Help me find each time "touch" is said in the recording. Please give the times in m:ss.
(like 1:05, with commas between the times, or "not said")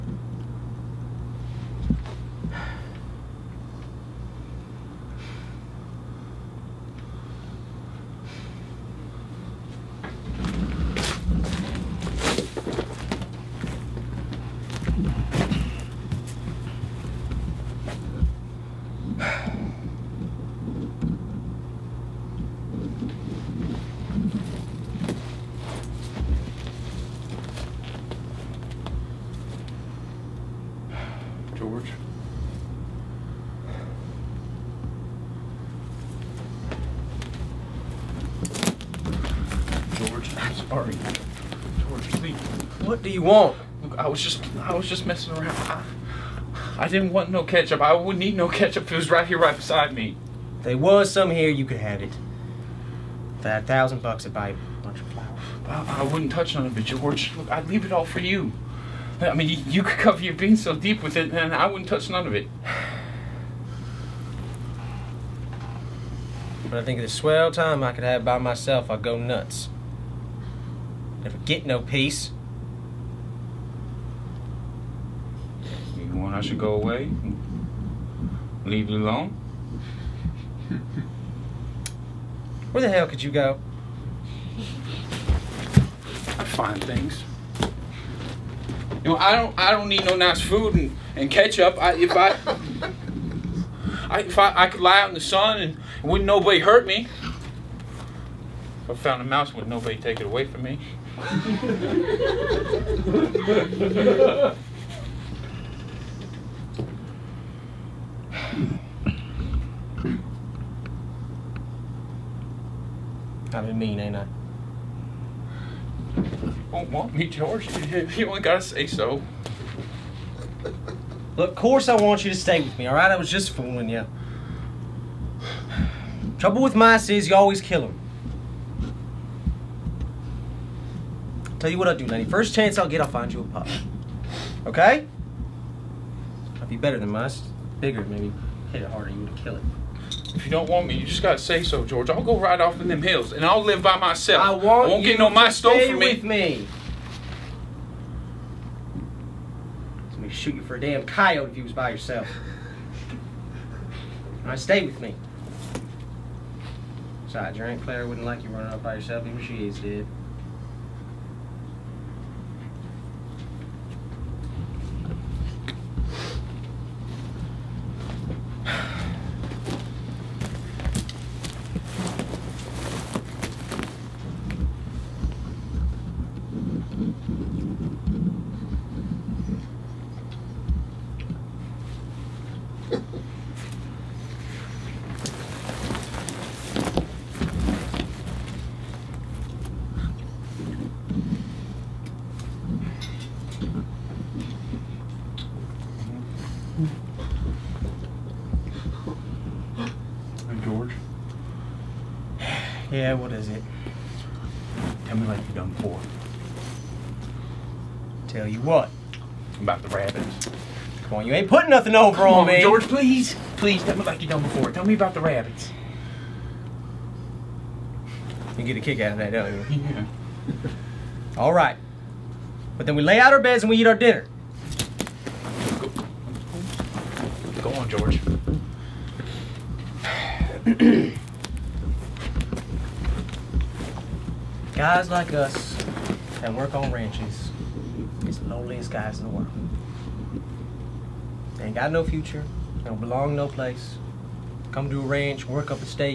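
0:56, 1:01.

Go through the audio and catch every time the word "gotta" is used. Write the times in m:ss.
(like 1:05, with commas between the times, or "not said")
1:58, 2:21.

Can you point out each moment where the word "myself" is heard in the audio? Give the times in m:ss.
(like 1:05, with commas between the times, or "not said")
1:08, 2:23.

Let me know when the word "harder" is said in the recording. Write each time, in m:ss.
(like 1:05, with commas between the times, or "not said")
2:18.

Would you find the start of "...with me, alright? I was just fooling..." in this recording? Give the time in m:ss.
2:02.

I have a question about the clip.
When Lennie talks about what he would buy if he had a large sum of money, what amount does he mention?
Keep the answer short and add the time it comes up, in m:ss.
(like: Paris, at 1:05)
$1,000, at 0:53.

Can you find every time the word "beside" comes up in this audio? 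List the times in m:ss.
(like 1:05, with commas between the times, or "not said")
0:49, 2:37.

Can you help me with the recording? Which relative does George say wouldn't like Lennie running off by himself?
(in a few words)
Aunt Claire.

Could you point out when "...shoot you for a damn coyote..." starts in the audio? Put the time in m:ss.
2:30.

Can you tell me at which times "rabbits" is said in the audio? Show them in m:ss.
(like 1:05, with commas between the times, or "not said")
3:29, 3:35.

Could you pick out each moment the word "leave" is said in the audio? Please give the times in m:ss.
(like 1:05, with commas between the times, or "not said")
0:57, 1:18.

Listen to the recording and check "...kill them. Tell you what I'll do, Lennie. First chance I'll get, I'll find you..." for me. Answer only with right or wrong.
right.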